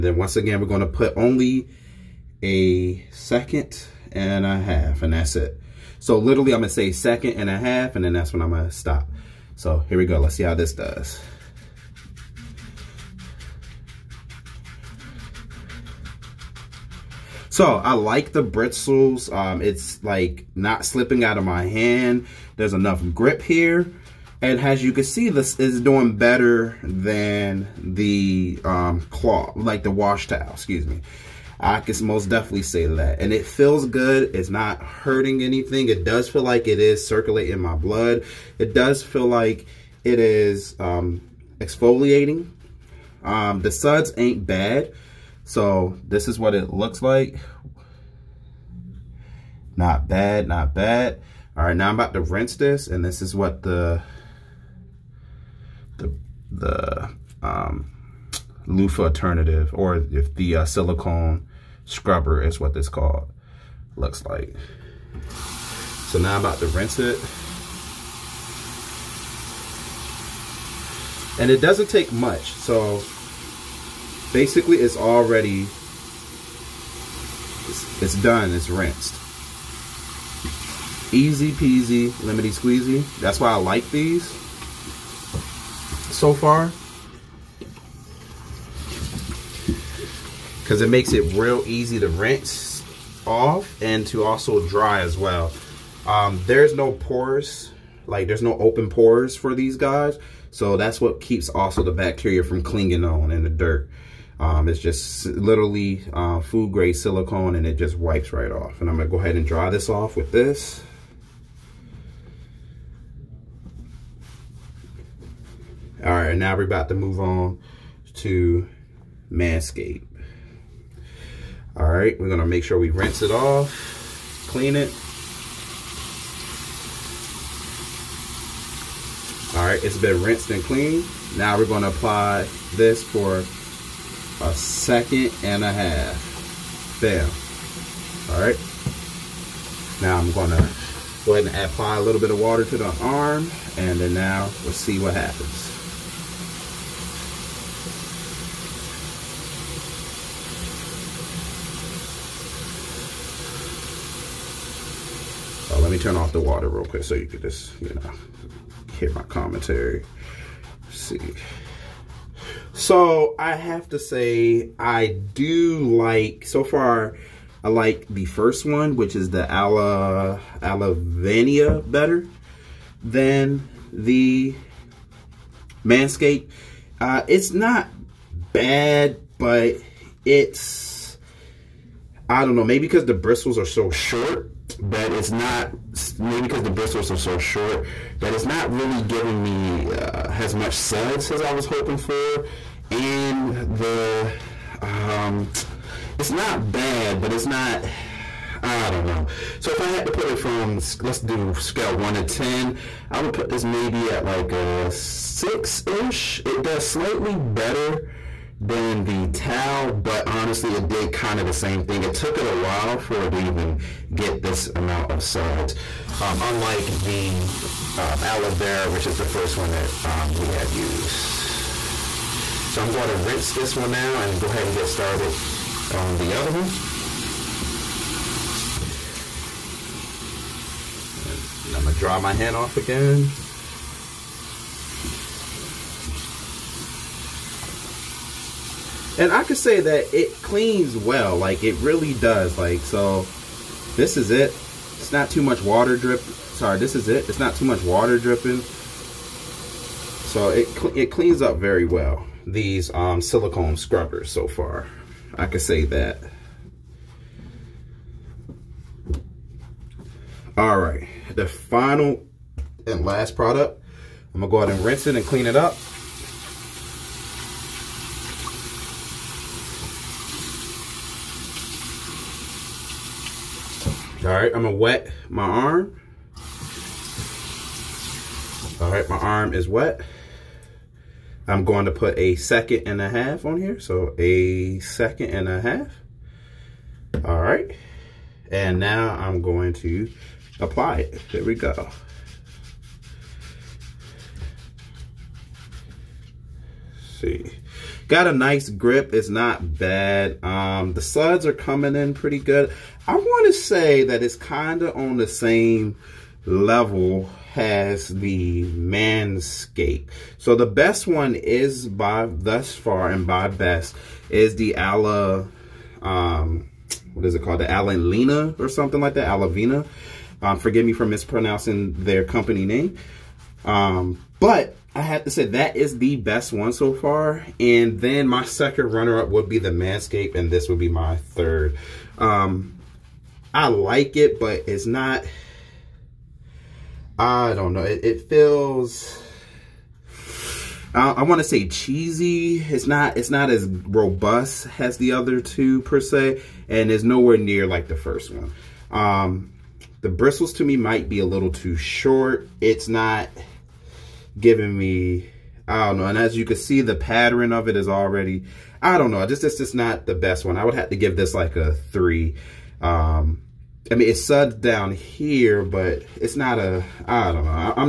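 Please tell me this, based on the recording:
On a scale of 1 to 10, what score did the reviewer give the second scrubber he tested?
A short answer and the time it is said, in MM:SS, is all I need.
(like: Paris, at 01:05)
6, at 03:24.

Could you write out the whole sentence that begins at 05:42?
It's not, it's not as robust as the other two per se, and it's nowhere near like the first one.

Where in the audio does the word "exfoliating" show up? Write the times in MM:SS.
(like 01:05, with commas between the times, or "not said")
00:41.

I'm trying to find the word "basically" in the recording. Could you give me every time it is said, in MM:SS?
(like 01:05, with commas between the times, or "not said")
01:14.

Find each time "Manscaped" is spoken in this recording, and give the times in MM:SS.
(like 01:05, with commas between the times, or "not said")
01:59, 02:55, 05:08, 05:29.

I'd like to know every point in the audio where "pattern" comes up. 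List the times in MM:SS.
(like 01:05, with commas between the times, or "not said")
05:56.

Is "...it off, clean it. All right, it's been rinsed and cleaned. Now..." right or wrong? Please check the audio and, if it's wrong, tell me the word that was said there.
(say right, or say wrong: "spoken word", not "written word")
right.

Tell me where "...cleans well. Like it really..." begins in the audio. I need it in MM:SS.
04:00.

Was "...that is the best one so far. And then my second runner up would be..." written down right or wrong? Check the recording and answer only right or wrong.
right.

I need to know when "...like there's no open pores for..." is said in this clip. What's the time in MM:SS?
01:38.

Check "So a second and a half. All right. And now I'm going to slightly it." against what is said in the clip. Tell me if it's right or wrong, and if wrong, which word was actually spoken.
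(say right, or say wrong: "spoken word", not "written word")
wrong: "apply", not "slightly".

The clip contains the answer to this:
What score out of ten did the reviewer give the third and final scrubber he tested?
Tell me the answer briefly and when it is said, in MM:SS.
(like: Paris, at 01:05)
3, at 06:01.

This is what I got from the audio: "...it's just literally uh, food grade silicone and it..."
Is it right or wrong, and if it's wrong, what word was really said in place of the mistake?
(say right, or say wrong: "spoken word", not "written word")
right.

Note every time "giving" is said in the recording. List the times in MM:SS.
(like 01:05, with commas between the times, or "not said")
03:09, 05:54.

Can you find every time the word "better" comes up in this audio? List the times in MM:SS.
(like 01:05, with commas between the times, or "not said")
00:26, 02:51, 03:27.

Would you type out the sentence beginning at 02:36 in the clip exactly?
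turn off the water real quick so you could just, you know, hear my commentary.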